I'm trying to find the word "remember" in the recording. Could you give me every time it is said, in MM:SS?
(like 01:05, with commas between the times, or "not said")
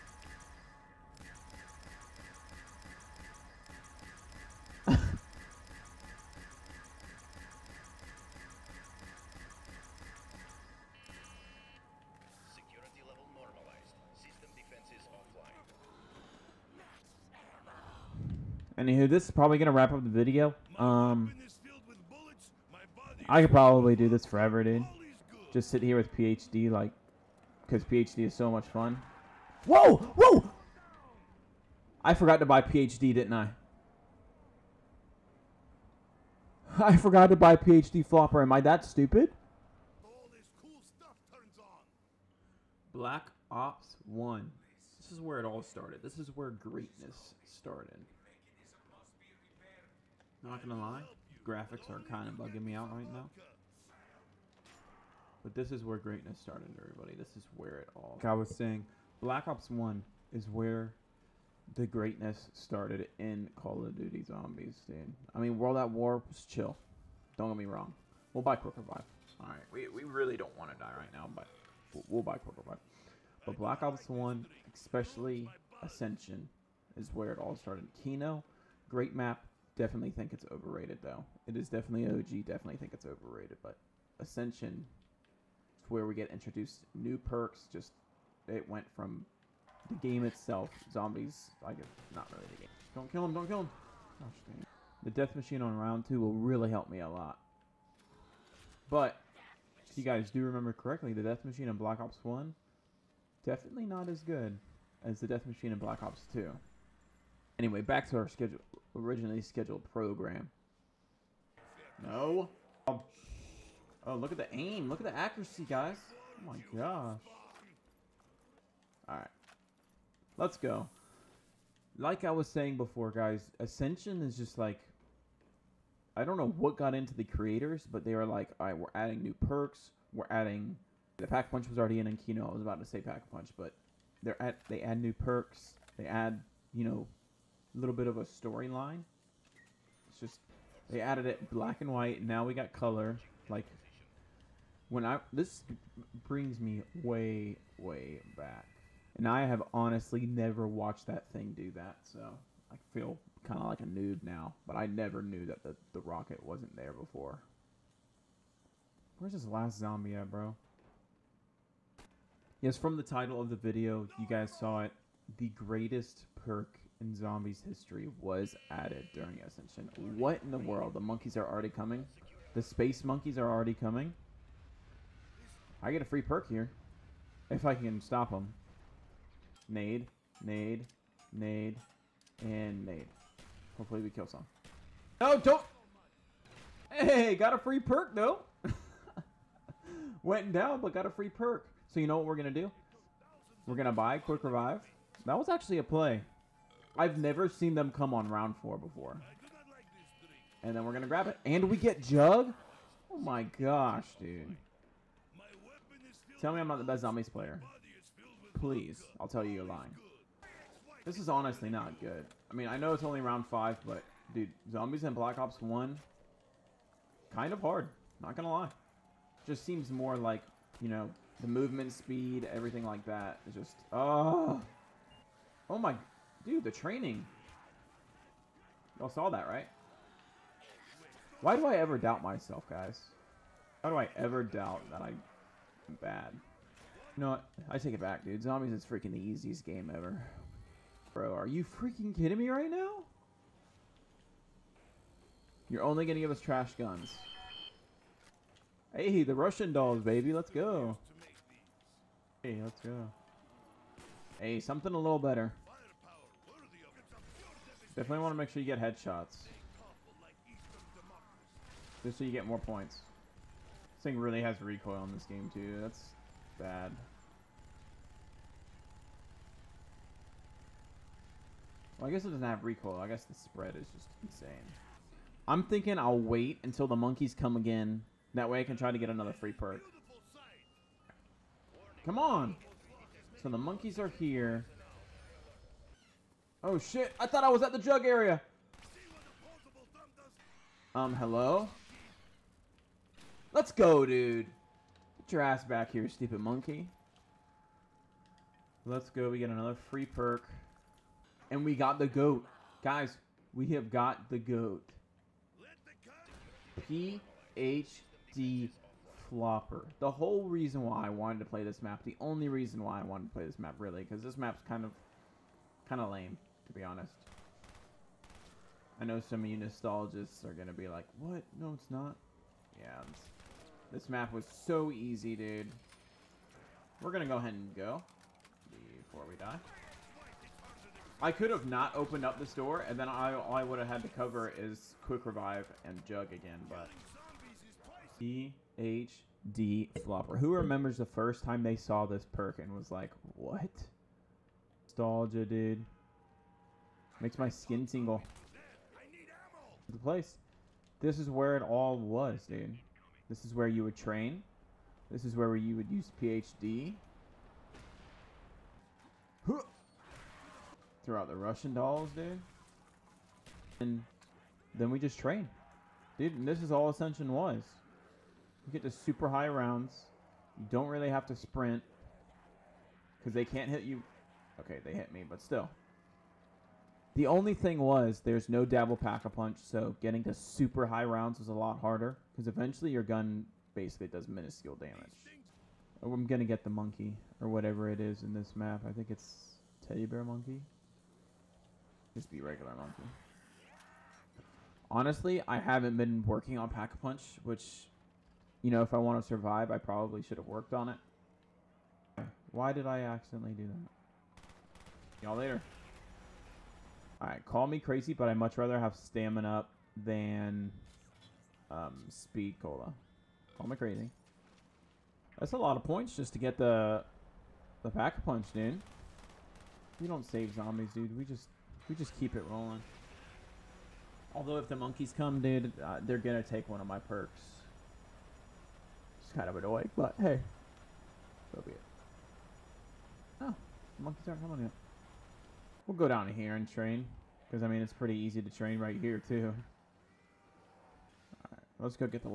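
01:40, 05:40.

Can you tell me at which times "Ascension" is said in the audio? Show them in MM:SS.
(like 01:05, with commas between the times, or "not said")
01:15, 01:24, 02:03, 02:49, 06:06.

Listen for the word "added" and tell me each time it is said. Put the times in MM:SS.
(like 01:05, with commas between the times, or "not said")
02:21, 02:48.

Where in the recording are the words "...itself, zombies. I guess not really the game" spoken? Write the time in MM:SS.
01:30.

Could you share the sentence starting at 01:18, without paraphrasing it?
Kino, great map, definitely think it's overrated though.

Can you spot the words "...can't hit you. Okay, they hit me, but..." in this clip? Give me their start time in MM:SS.
06:13.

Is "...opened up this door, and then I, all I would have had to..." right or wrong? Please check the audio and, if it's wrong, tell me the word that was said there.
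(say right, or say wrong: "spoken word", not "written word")
right.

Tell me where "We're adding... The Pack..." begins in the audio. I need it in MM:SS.
02:10.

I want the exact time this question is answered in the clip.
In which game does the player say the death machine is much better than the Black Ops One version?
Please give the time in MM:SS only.
01:45.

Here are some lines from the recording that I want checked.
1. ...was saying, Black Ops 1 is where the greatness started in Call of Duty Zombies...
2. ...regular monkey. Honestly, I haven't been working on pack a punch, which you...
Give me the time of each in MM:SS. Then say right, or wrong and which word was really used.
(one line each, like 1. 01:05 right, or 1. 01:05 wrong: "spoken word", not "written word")
1. 00:58 right
2. 06:32 right.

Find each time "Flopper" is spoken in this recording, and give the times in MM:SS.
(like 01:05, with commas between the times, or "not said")
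00:38, 05:09, 05:40.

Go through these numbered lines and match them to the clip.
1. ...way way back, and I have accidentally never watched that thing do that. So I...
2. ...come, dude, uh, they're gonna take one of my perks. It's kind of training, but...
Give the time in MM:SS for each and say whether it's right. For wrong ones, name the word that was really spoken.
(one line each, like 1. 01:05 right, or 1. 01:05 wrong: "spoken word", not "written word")
1. 02:27 wrong: "honestly", not "accidentally"
2. 07:05 wrong: "annoying", not "training".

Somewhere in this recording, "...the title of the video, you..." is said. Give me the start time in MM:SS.
02:42.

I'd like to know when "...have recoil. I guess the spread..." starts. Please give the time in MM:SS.
04:32.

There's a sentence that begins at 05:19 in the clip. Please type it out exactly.
I know some of you nostalgists are going to be like, what?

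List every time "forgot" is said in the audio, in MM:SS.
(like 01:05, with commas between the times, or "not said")
00:32, 00:36.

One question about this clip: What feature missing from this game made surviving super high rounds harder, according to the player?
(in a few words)
double pack a punch.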